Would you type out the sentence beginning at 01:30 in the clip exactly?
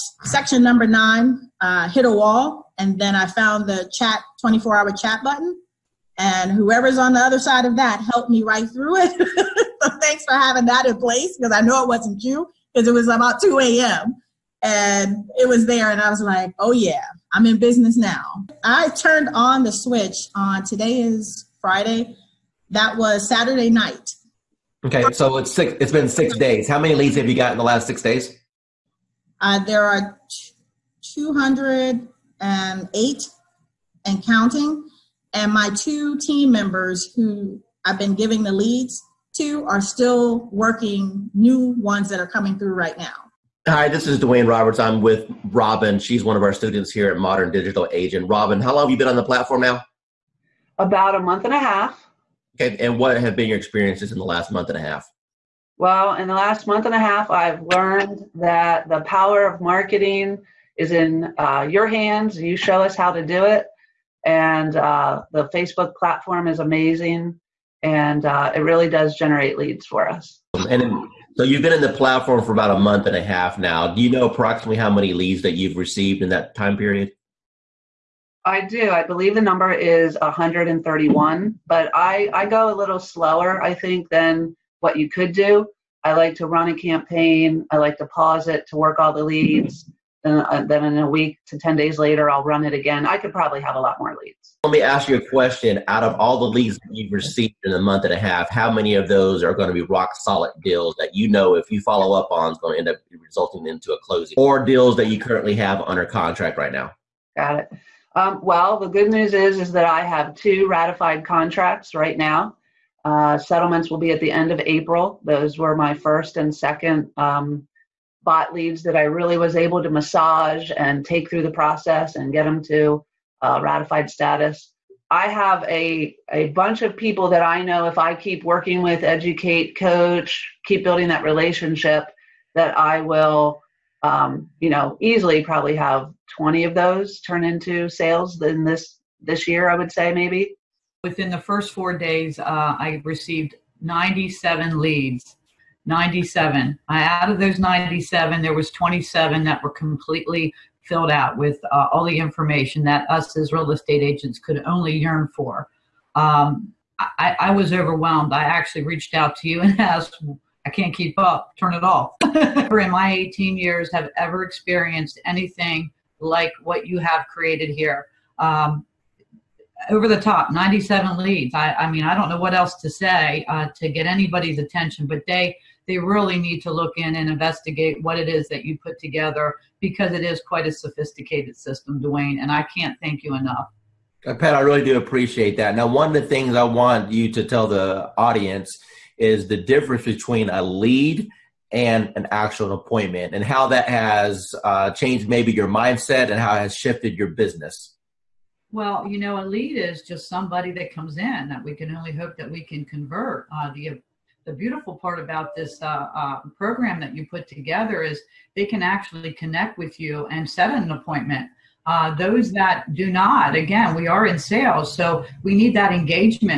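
Uh, then in a week to 10 days later, I'll run it again.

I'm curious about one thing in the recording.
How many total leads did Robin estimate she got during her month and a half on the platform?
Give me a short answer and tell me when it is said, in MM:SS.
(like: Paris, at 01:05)
131, at 01:20.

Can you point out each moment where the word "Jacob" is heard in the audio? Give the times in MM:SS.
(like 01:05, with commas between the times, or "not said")
not said.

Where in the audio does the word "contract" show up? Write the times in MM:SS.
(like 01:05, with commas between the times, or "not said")
01:46, 01:51.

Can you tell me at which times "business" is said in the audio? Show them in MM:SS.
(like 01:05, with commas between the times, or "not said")
00:17, 03:17.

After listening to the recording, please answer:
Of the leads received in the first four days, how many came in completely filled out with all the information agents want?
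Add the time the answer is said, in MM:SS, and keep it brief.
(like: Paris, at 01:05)
27, at 02:28.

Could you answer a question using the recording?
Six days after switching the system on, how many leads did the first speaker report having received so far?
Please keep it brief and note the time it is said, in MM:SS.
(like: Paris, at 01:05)
208, at 00:31.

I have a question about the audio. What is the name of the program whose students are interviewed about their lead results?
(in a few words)
Modern Digital Agent.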